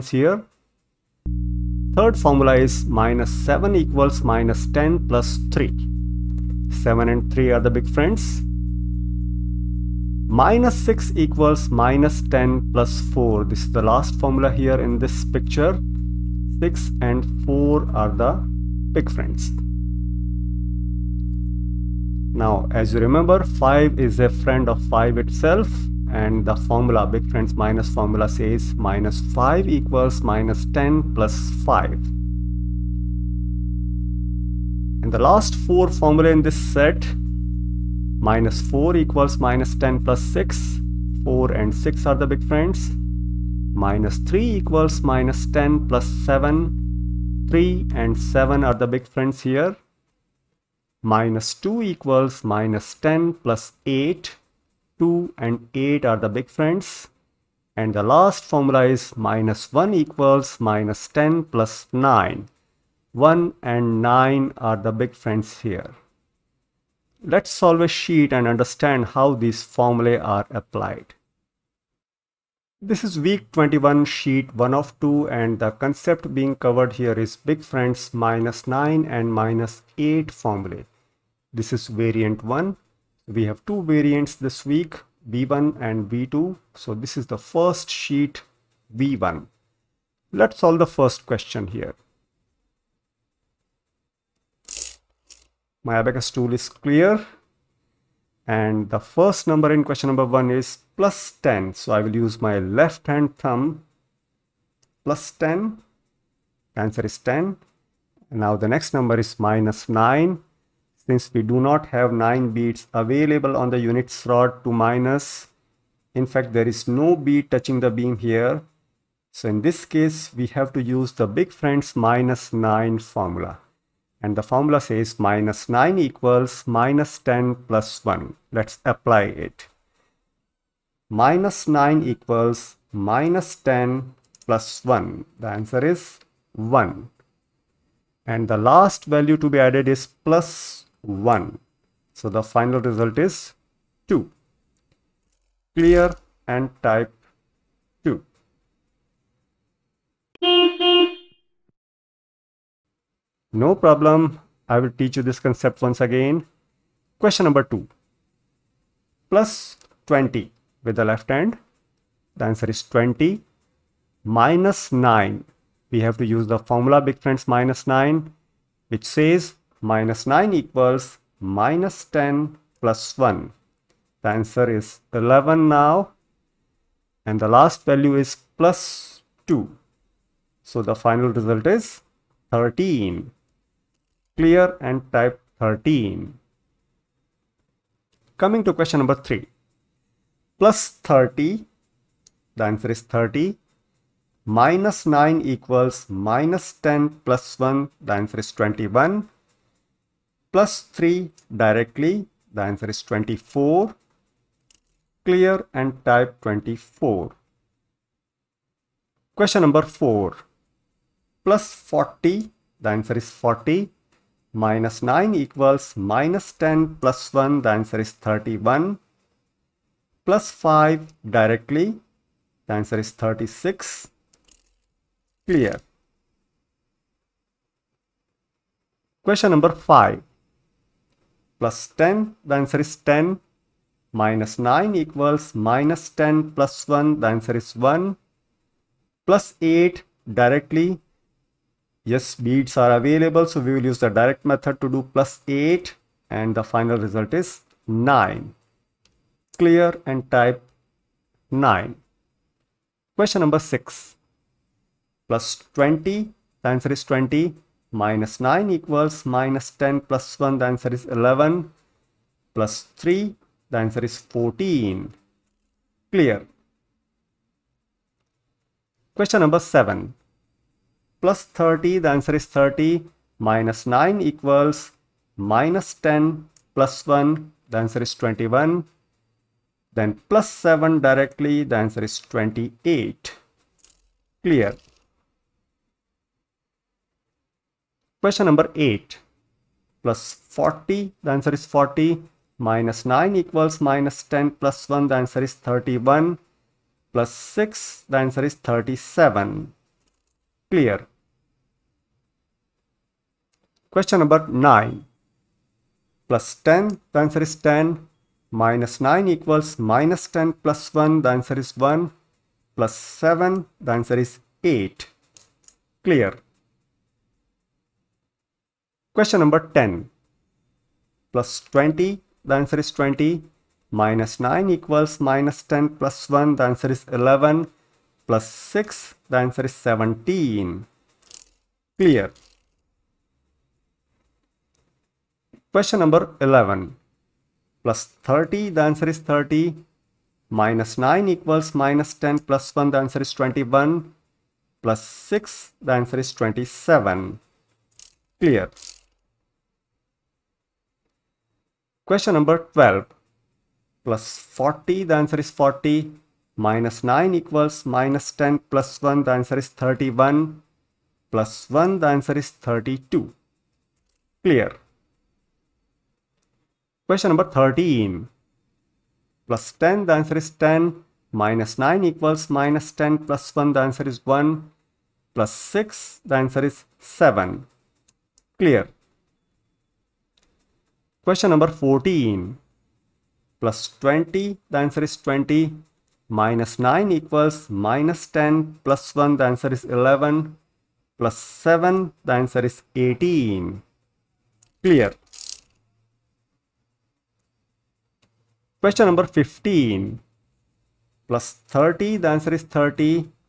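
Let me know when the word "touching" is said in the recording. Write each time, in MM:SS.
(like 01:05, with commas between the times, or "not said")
01:57.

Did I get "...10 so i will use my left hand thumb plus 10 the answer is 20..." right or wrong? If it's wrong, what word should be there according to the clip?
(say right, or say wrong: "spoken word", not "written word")
wrong: "10", not "20".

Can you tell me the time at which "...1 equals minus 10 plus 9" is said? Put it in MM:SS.
00:59.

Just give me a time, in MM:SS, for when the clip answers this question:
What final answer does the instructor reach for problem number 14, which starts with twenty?
06:32.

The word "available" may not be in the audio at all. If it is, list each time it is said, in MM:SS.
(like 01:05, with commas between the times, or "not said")
01:53, 04:02.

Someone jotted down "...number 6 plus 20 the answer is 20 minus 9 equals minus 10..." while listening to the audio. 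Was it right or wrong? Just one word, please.
right.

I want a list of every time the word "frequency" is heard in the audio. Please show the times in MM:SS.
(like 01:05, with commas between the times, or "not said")
not said.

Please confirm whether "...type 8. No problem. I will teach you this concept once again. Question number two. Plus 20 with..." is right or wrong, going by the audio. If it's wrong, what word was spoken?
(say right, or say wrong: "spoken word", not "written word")
wrong: "2", not "8".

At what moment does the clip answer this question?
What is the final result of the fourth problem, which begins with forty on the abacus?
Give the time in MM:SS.
03:43.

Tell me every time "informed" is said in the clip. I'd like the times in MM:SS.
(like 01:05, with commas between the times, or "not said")
not said.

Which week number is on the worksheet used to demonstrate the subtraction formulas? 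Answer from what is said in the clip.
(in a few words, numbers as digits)
21.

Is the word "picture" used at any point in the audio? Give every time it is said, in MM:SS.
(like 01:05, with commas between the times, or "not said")
00:15.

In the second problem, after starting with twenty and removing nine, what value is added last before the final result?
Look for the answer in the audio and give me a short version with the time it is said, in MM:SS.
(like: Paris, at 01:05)
2, at 02:58.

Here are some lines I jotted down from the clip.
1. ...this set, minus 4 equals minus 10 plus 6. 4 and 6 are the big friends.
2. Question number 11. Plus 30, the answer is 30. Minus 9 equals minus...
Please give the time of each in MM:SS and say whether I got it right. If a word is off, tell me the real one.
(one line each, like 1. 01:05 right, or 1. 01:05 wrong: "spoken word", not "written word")
1. 00:36 right
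2. 05:35 right.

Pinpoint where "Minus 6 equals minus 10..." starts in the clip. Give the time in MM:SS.
00:10.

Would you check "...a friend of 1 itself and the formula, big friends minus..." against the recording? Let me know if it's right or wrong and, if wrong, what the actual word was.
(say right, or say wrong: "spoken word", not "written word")
wrong: "5", not "1".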